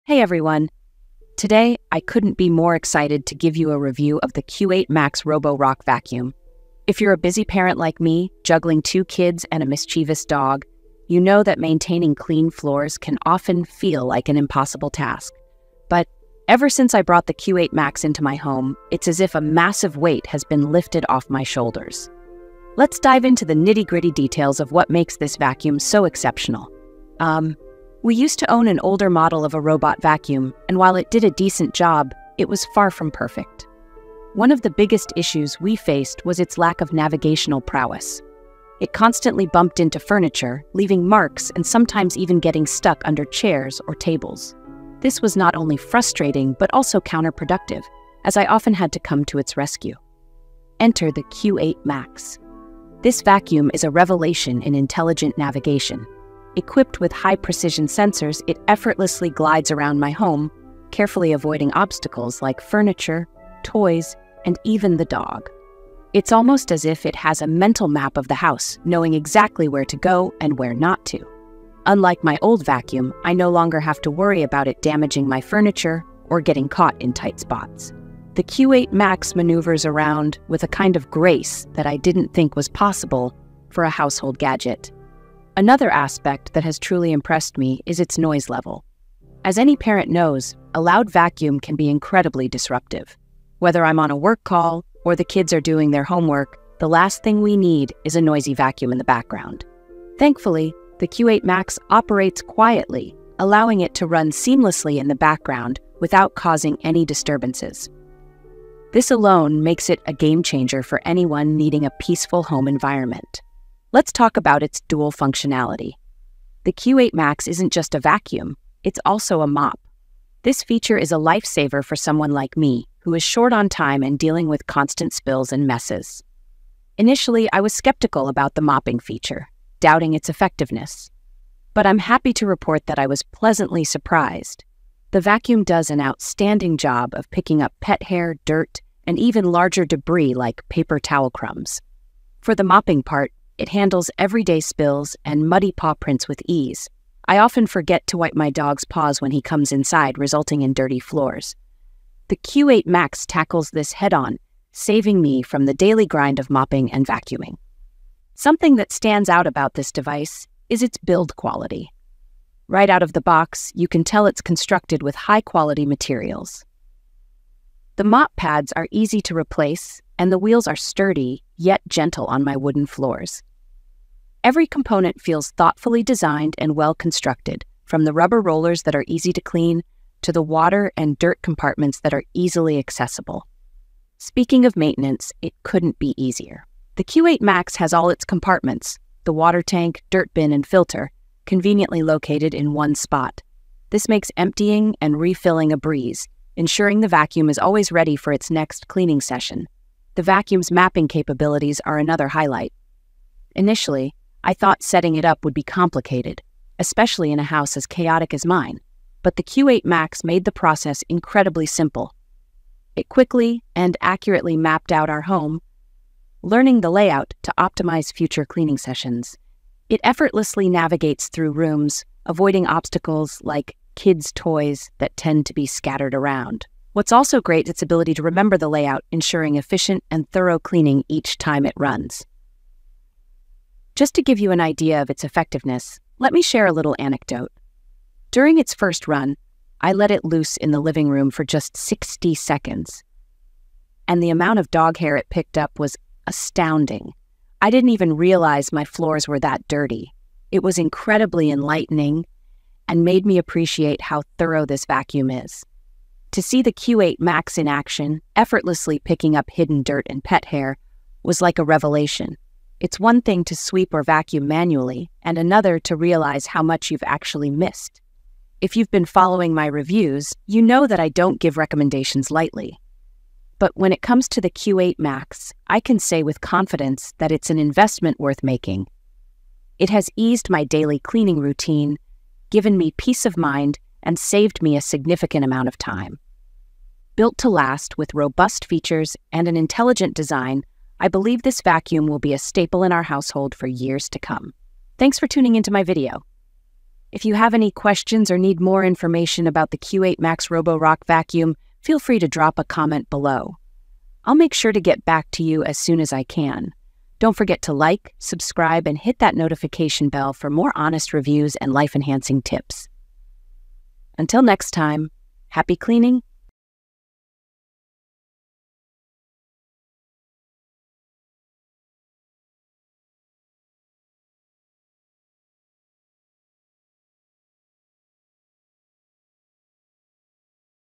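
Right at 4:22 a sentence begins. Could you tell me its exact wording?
It's one thing to sweep or vacuum manually, and another to realize how much you've actually missed.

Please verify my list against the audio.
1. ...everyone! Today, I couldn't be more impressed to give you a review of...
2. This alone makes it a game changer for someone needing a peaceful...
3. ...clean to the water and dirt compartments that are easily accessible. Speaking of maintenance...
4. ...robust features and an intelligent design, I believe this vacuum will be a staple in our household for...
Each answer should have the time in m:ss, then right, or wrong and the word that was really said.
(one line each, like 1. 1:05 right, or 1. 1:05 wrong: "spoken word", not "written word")
1. 0:00 wrong: "excited", not "impressed"
2. 1:48 wrong: "anyone", not "someone"
3. 2:59 right
4. 4:48 right.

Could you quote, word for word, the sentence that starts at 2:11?
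But I'm happy to report that I was pleasantly surprised.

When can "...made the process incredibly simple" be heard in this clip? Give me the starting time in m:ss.
3:30.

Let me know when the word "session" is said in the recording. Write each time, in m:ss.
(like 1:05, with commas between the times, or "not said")
3:19, 3:38.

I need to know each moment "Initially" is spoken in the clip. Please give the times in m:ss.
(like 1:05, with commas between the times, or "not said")
2:06, 3:23.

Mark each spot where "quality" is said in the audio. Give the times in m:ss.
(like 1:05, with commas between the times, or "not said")
2:41, 2:45.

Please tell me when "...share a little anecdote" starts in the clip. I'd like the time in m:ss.
3:56.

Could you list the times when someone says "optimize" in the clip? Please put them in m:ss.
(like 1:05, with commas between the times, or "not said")
3:37.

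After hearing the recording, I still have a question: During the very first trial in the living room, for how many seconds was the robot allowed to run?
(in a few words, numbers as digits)
60.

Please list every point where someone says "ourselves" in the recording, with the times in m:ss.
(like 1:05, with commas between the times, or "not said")
not said.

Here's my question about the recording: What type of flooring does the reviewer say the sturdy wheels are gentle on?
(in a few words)
wooden floors.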